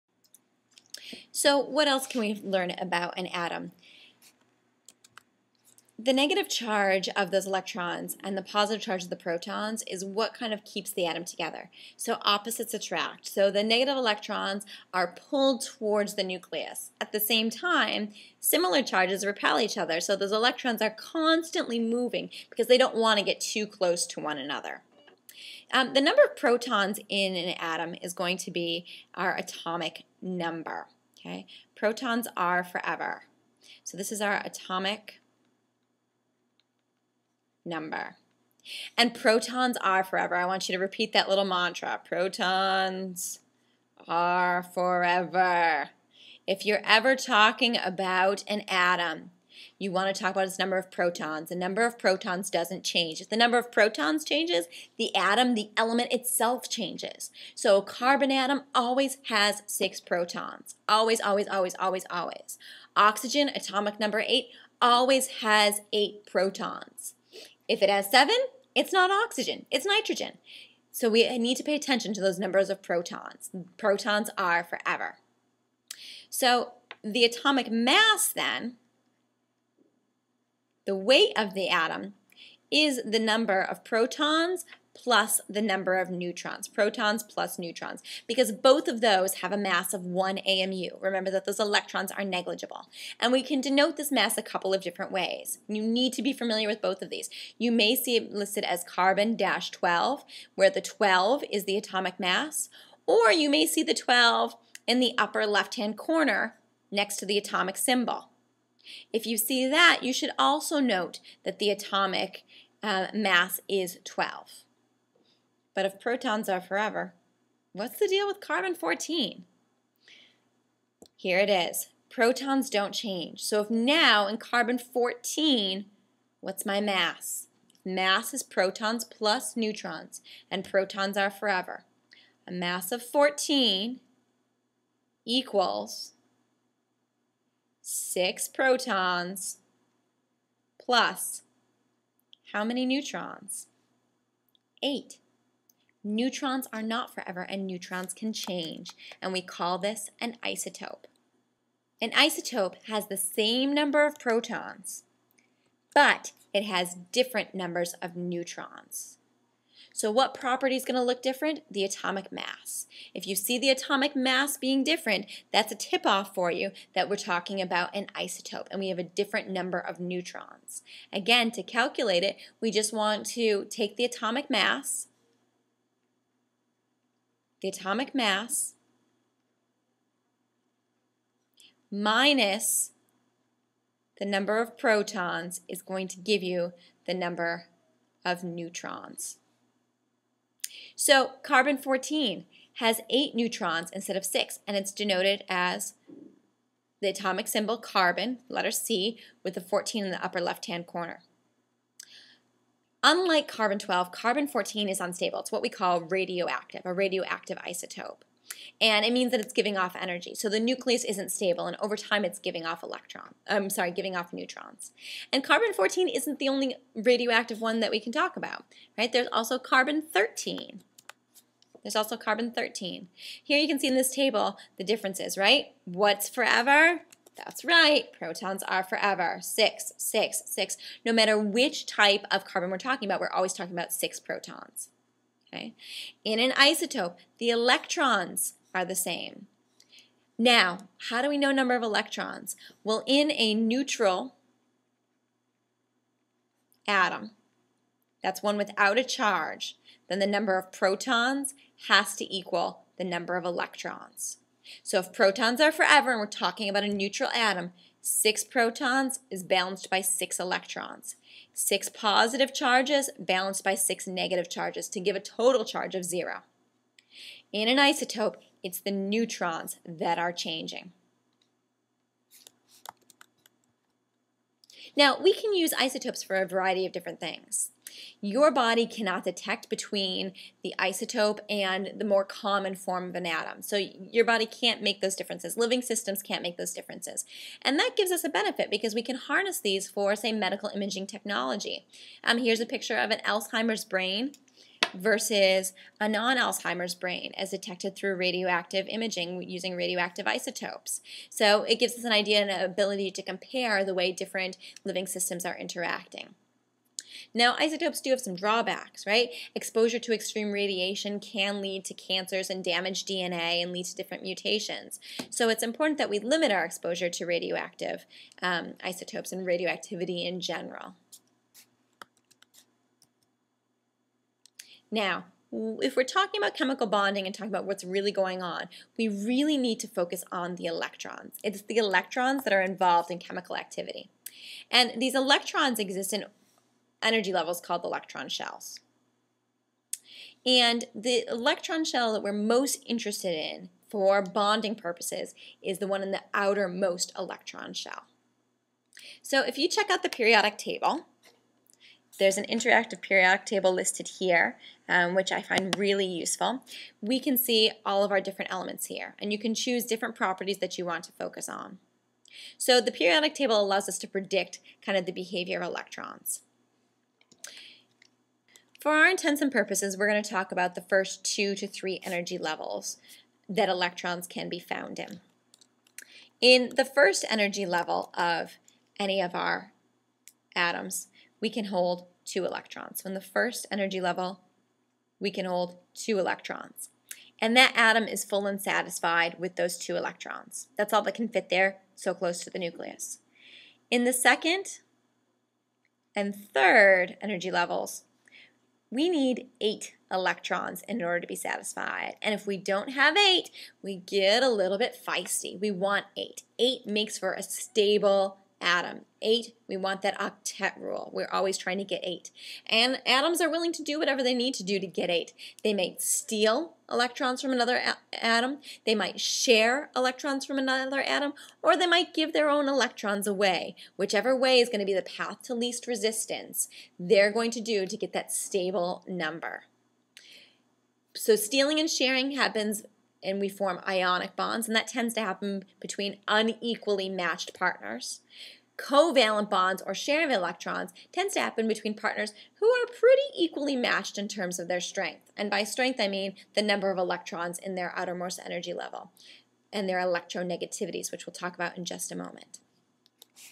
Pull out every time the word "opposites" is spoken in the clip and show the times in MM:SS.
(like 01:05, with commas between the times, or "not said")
00:12.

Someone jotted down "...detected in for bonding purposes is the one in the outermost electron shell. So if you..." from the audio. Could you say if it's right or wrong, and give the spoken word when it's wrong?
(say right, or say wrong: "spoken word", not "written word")
wrong: "interested", not "detected".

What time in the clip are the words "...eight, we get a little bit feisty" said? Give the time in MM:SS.
06:43.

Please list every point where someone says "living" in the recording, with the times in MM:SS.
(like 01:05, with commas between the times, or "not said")
04:45, 05:04.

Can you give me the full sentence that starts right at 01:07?
If it has seven, it's not oxygen, it's nitrogen.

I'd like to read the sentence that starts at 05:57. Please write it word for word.
We can see all of our different elements here, and you can choose different properties that you want to focus on.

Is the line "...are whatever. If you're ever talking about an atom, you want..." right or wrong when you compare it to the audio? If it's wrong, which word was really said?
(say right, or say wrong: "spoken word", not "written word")
wrong: "forever", not "whatever".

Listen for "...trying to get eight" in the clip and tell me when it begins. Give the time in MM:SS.
06:51.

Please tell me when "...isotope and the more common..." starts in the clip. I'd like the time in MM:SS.
04:40.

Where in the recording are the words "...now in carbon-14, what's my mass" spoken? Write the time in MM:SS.
02:03.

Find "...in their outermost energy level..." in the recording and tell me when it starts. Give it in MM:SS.
07:27.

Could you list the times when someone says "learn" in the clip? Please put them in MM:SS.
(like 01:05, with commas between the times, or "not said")
00:02.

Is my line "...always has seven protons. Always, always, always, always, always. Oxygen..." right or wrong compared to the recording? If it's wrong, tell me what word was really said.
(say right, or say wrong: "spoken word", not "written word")
wrong: "six", not "seven".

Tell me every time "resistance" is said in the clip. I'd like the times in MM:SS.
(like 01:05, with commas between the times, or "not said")
07:05.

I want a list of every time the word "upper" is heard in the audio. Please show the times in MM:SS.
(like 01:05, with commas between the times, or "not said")
01:45, 03:20.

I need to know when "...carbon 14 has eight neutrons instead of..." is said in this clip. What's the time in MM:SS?
03:11.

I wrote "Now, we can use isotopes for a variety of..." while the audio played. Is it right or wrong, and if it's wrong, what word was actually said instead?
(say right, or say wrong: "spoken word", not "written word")
right.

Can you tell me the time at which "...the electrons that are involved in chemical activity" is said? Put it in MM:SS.
05:31.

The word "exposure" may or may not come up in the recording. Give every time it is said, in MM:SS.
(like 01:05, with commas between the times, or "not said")
05:09, 05:16.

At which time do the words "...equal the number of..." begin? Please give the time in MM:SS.
04:12.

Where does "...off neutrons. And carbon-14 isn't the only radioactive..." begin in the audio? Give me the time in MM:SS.
03:34.